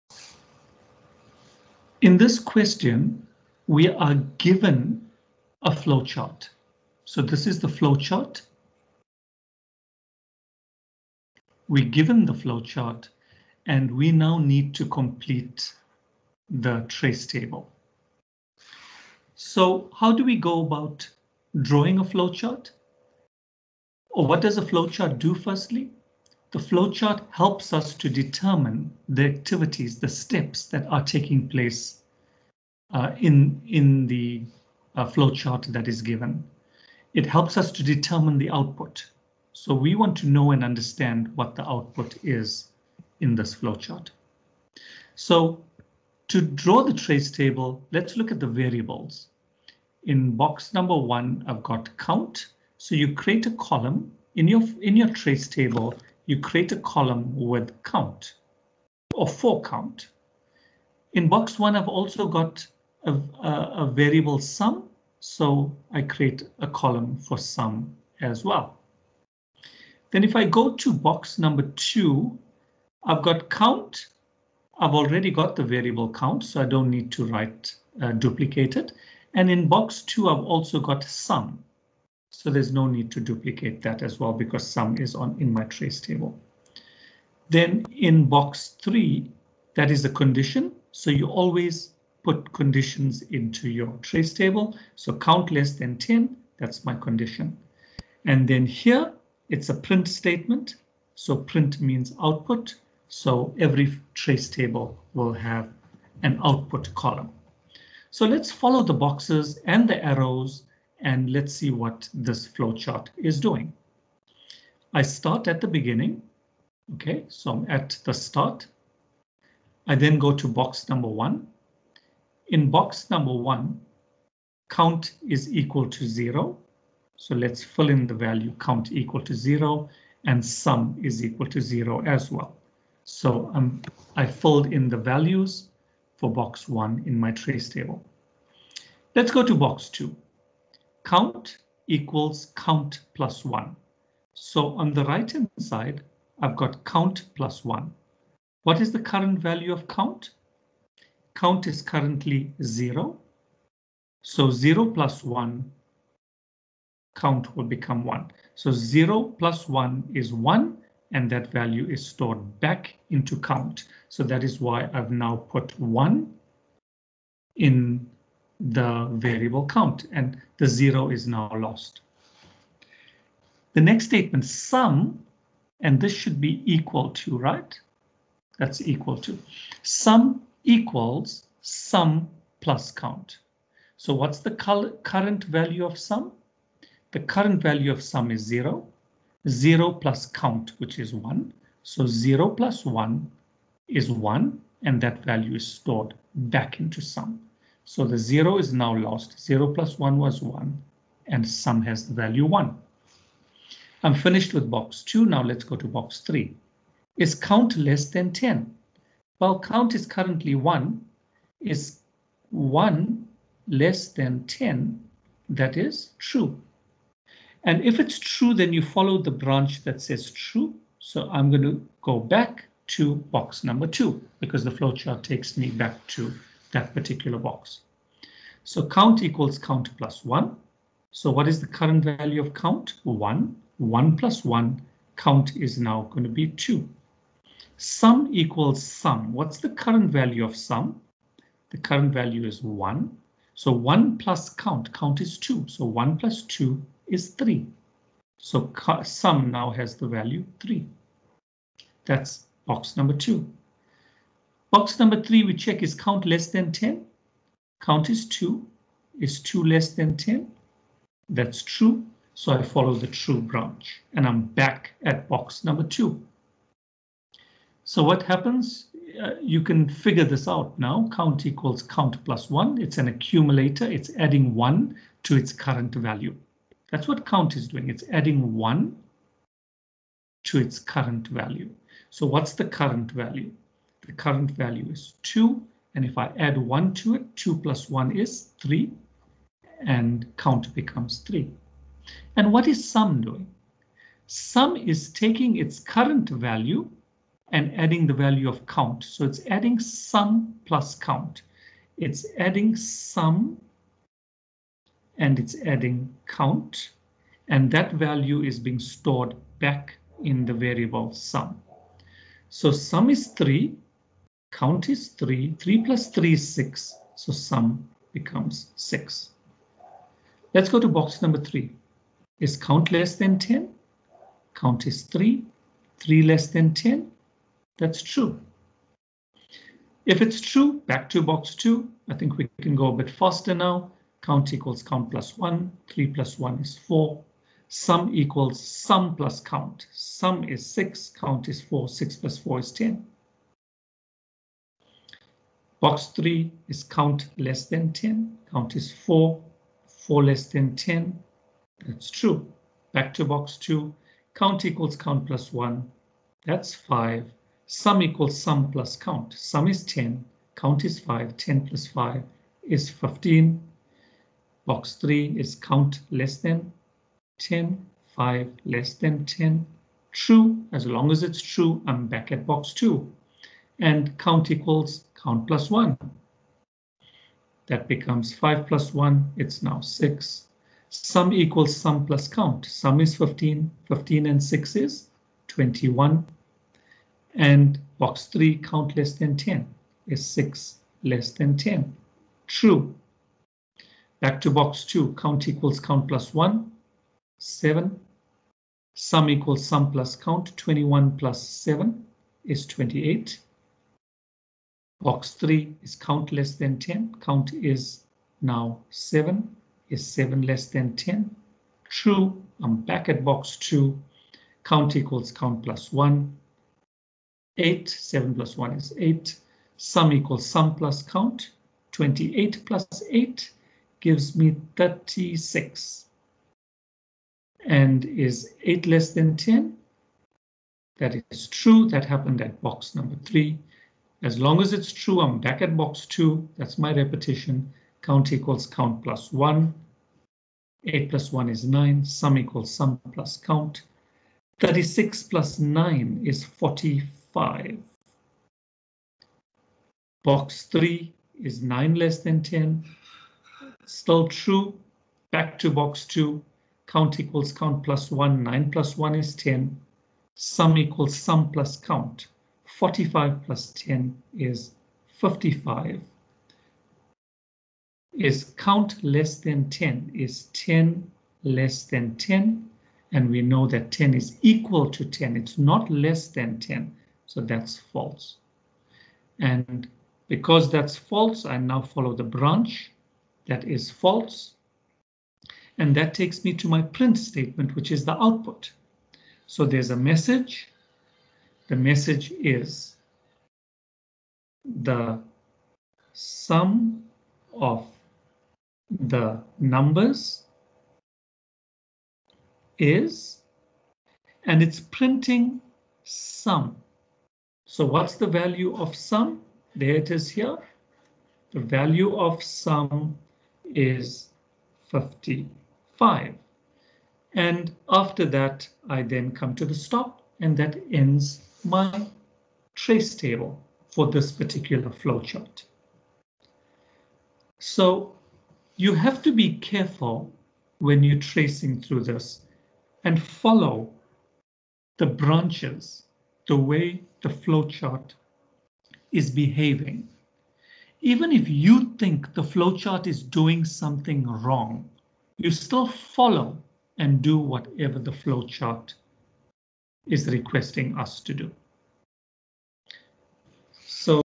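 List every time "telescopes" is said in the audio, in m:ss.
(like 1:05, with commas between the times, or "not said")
not said.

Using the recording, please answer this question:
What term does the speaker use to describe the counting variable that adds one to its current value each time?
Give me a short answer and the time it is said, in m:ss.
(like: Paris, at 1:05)
Accumulator, at 4:32.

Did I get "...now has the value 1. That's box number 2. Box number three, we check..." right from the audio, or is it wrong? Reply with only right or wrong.
wrong.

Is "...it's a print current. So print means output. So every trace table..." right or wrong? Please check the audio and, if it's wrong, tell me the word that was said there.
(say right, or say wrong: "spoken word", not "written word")
wrong: "statement", not "current".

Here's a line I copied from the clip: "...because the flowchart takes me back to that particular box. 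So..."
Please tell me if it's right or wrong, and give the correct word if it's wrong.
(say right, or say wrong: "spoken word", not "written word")
right.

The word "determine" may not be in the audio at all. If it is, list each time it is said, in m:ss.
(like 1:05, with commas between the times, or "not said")
0:28, 0:37.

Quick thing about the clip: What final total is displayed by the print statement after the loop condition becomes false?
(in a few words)
55.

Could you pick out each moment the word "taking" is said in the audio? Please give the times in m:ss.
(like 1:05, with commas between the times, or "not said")
0:31, 4:55.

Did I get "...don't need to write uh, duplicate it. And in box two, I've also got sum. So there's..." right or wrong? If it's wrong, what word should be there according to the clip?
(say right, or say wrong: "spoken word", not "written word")
right.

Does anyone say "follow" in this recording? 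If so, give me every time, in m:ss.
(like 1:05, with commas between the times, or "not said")
1:48, 3:38, 4:22, 8:01, 8:53, 9:05.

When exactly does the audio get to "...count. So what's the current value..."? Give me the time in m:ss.
3:02.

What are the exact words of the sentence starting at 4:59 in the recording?
So it's adding sum plus count.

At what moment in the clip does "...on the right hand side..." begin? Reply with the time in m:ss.
2:24.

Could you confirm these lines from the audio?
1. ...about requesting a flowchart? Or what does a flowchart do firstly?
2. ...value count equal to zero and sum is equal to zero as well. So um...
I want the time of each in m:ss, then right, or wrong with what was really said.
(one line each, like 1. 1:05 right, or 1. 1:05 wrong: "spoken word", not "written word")
1. 0:20 wrong: "drawing", not "requesting"
2. 2:08 right.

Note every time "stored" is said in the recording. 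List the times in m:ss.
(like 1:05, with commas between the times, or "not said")
2:42, 3:15, 5:08.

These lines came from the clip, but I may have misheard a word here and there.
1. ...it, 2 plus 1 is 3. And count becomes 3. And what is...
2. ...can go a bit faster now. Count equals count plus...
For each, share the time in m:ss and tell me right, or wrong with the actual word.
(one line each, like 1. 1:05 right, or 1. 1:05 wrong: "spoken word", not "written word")
1. 4:47 right
2. 5:32 right.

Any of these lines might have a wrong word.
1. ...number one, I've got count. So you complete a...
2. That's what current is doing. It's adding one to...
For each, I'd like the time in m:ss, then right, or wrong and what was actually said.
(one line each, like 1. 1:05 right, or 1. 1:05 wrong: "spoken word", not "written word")
1. 0:50 wrong: "create", not "complete"
2. 4:36 wrong: "count", not "current".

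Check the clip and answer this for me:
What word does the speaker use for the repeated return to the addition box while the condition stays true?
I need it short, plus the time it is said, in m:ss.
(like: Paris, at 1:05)
Repetition, at 7:16.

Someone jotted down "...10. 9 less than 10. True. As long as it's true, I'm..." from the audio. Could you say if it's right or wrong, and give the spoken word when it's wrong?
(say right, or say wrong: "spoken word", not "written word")
wrong: "5", not "9".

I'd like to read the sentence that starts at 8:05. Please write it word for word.
And that takes me to my print statement, which is the output.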